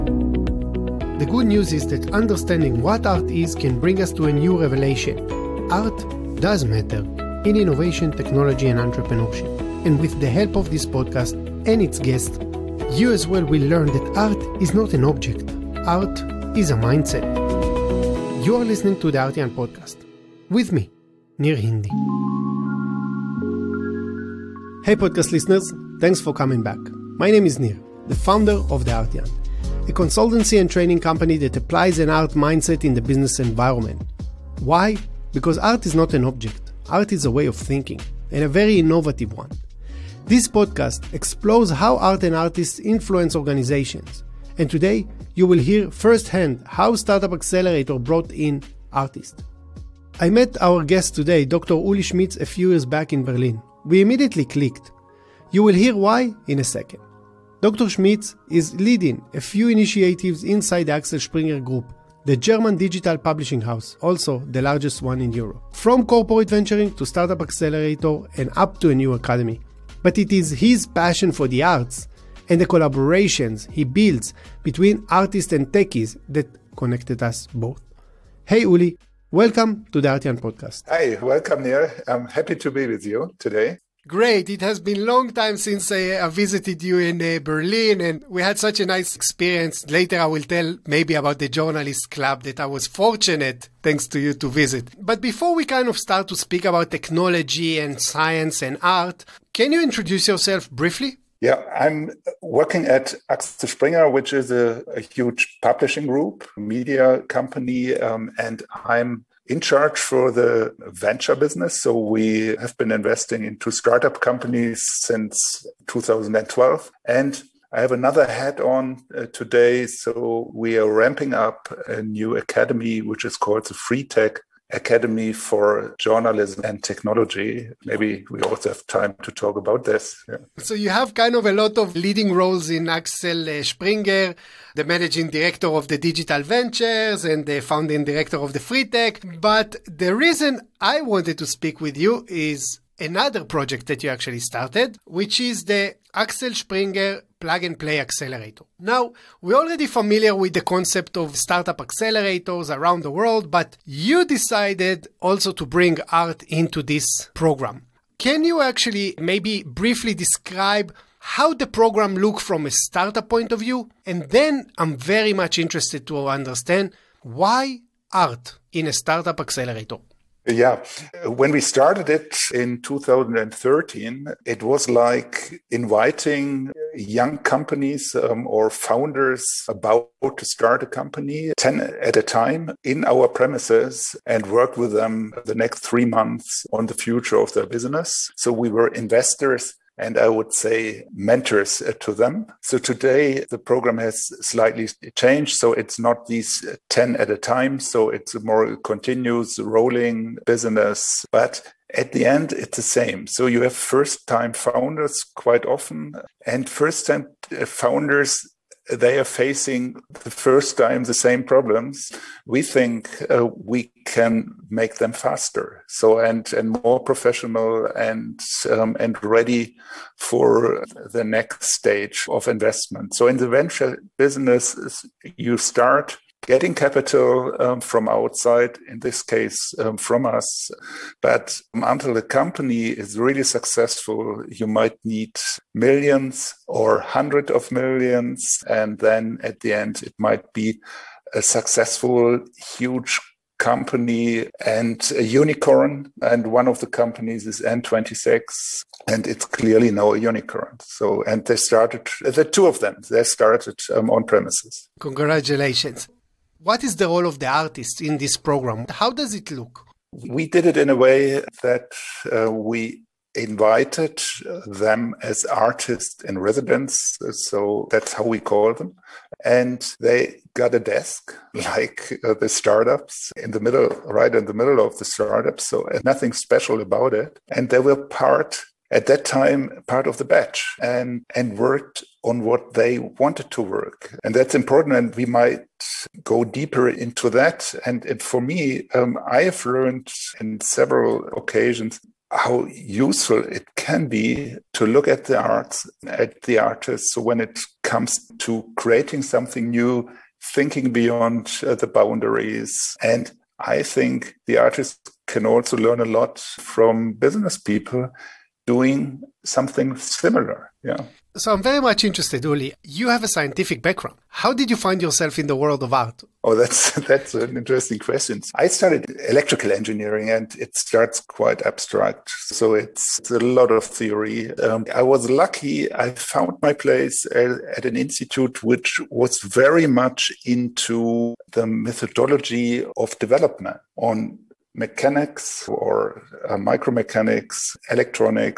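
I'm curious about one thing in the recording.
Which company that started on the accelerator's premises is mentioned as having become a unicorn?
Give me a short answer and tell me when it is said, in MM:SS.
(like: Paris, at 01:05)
N26, at 04:07.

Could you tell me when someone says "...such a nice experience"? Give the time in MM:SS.
01:28.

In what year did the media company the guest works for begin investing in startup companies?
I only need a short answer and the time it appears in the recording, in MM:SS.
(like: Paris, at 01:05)
2012, at 01:55.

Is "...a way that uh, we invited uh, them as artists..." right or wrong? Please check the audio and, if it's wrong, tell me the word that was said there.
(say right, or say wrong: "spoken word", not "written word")
right.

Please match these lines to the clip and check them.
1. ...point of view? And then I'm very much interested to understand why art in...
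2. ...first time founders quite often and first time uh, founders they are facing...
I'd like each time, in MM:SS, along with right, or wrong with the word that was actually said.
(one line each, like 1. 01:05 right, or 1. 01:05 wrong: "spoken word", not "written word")
1. 02:43 right
2. 03:23 right.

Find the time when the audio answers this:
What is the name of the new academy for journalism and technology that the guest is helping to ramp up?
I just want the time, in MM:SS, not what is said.
02:03.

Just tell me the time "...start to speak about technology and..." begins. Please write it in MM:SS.
01:35.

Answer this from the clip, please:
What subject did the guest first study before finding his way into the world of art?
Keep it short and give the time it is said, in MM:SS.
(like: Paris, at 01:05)
Electrical engineering, at 05:19.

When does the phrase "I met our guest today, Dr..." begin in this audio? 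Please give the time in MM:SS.
00:50.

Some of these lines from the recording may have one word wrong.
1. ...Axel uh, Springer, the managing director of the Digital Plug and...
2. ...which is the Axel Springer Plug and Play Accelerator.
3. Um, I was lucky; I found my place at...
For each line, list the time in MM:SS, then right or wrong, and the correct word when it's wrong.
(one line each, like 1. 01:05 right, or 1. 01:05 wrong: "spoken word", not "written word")
1. 02:12 wrong: "Ventures", not "Plug"
2. 02:25 right
3. 05:24 right.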